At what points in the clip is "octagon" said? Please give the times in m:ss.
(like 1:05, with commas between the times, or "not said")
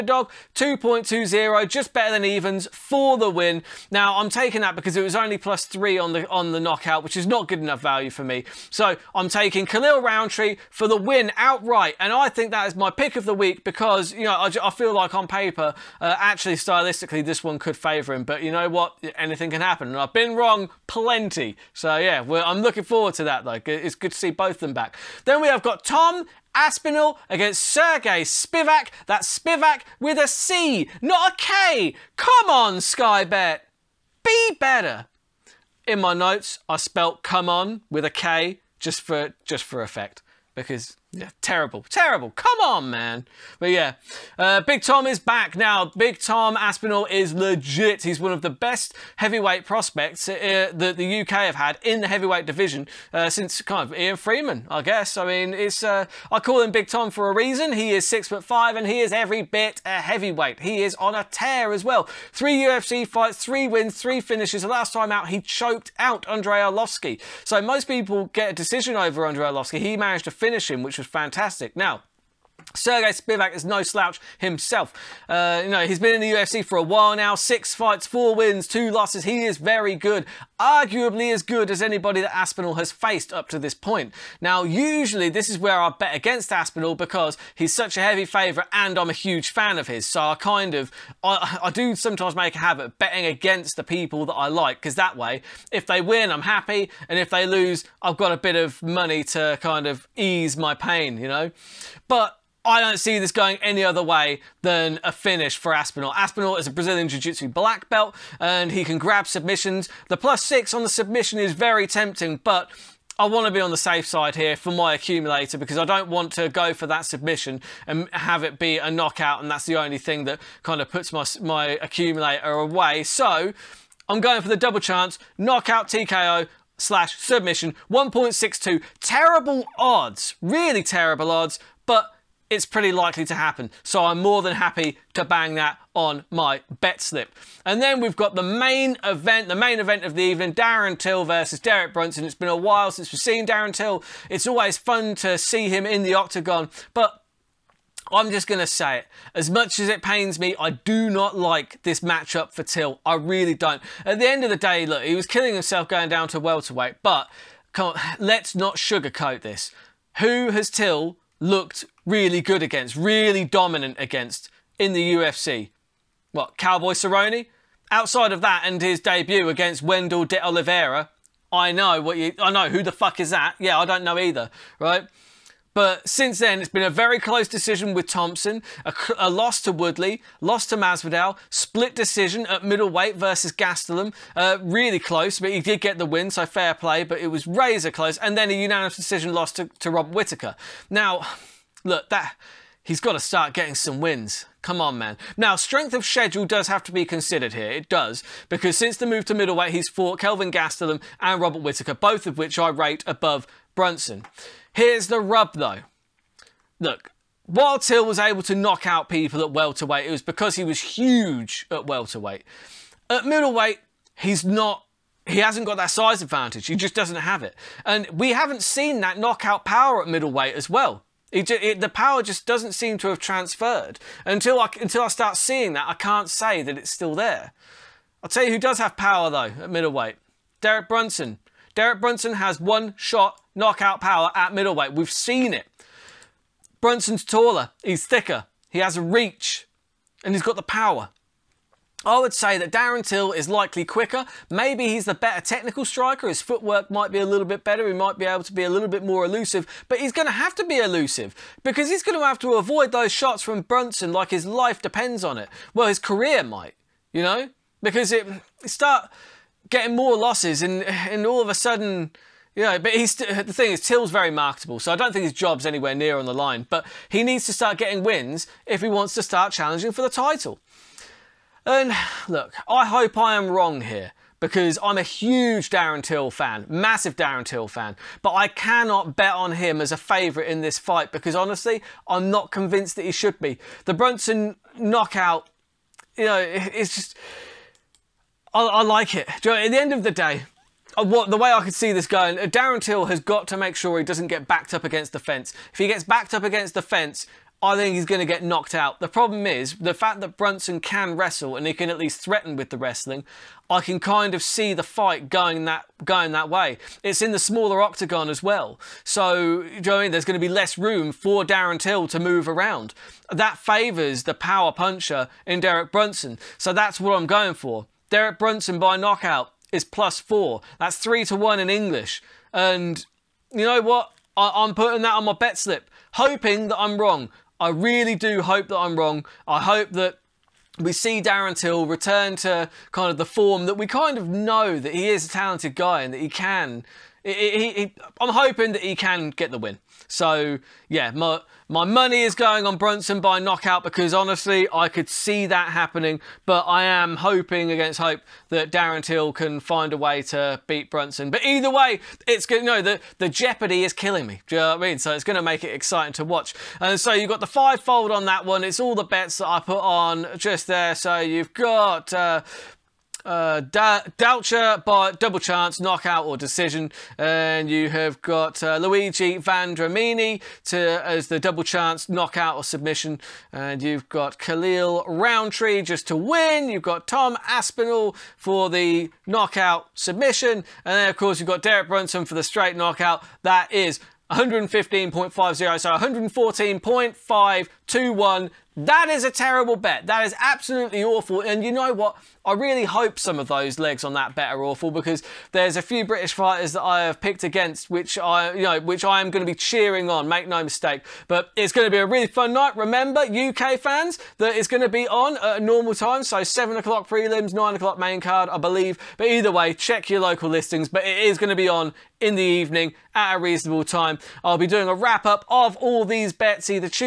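2:26, 5:07.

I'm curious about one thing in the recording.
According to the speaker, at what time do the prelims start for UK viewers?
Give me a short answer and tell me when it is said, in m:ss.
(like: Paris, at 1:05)
7 o'clock, at 6:46.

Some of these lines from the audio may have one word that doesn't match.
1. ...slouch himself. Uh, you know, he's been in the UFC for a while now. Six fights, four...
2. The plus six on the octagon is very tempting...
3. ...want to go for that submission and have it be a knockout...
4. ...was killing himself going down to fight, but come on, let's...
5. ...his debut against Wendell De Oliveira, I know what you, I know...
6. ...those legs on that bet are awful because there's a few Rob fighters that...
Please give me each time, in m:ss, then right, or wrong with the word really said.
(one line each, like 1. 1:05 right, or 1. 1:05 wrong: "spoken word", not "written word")
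1. 1:13 right
2. 1:50 wrong: "submission", not "octagon"
3. 1:56 right
4. 2:35 wrong: "welterweight", not "fight"
5. 2:48 right
6. 6:33 wrong: "British", not "Rob".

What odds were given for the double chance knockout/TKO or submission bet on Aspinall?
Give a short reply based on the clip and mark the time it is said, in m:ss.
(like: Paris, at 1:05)
1.62, at 2:07.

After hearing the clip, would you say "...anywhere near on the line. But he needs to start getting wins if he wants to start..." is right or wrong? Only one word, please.
right.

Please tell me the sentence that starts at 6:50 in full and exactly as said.
But it is going to be on in the evening at a reasonable time.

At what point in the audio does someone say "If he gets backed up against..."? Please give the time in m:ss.
4:55.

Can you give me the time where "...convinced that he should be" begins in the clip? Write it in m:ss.
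4:42.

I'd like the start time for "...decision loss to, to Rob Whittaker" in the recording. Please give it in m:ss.
3:08.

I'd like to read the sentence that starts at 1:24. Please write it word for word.
Now, usually this is where I bet against Aspinall because he's such a heavy favourite and I'm a huge fan of his.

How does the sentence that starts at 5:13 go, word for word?
That favours the power puncher in Derek Brunson, so that's what I'm going for.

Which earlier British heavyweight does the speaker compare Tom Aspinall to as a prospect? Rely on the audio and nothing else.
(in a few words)
Ian Freeman.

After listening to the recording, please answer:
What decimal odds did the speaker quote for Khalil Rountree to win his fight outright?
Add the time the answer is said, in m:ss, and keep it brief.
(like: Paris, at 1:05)
2.20, at 0:00.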